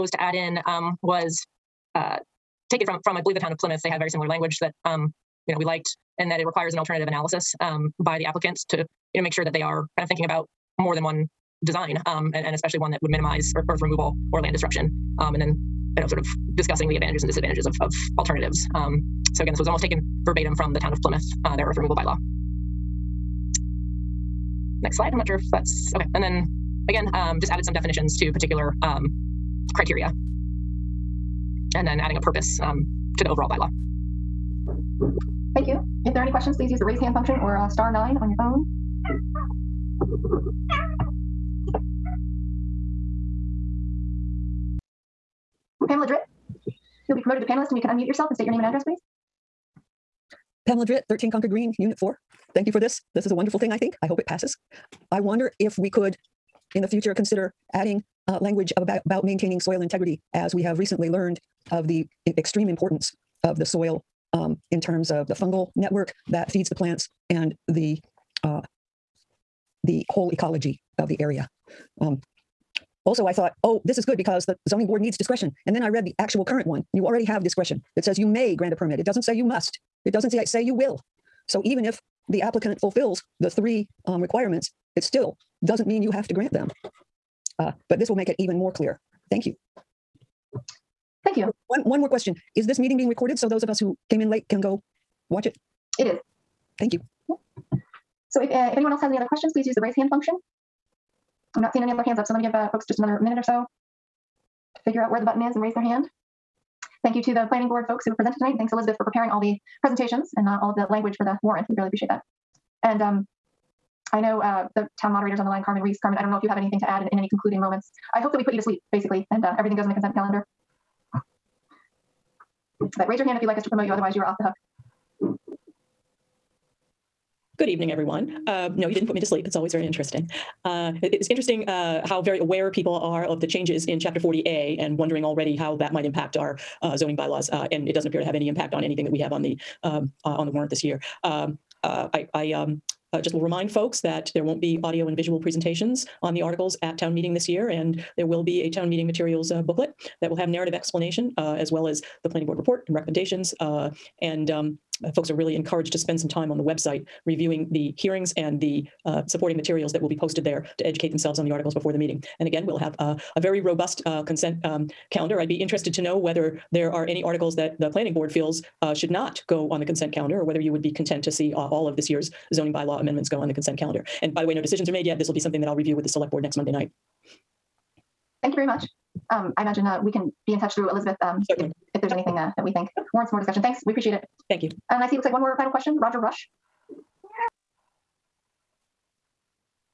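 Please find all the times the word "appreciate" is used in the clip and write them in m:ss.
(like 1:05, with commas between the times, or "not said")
1:51, 3:03.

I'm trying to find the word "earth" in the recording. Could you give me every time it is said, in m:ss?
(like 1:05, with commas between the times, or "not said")
0:13, 0:21.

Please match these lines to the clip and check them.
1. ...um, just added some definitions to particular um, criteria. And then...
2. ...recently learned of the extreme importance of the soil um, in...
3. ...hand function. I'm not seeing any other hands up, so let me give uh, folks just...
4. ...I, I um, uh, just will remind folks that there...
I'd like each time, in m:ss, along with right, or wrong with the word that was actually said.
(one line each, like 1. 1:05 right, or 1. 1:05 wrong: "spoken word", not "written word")
1. 0:27 right
2. 1:00 right
3. 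1:39 right
4. 2:22 right.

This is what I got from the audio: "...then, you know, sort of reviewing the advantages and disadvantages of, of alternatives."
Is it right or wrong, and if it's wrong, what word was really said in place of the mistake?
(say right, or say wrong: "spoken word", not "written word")
wrong: "discussing", not "reviewing".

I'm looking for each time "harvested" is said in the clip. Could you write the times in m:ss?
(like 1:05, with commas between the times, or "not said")
not said.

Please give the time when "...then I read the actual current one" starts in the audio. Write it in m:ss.
1:15.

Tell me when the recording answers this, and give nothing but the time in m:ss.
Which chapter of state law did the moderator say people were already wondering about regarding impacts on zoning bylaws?
2:13.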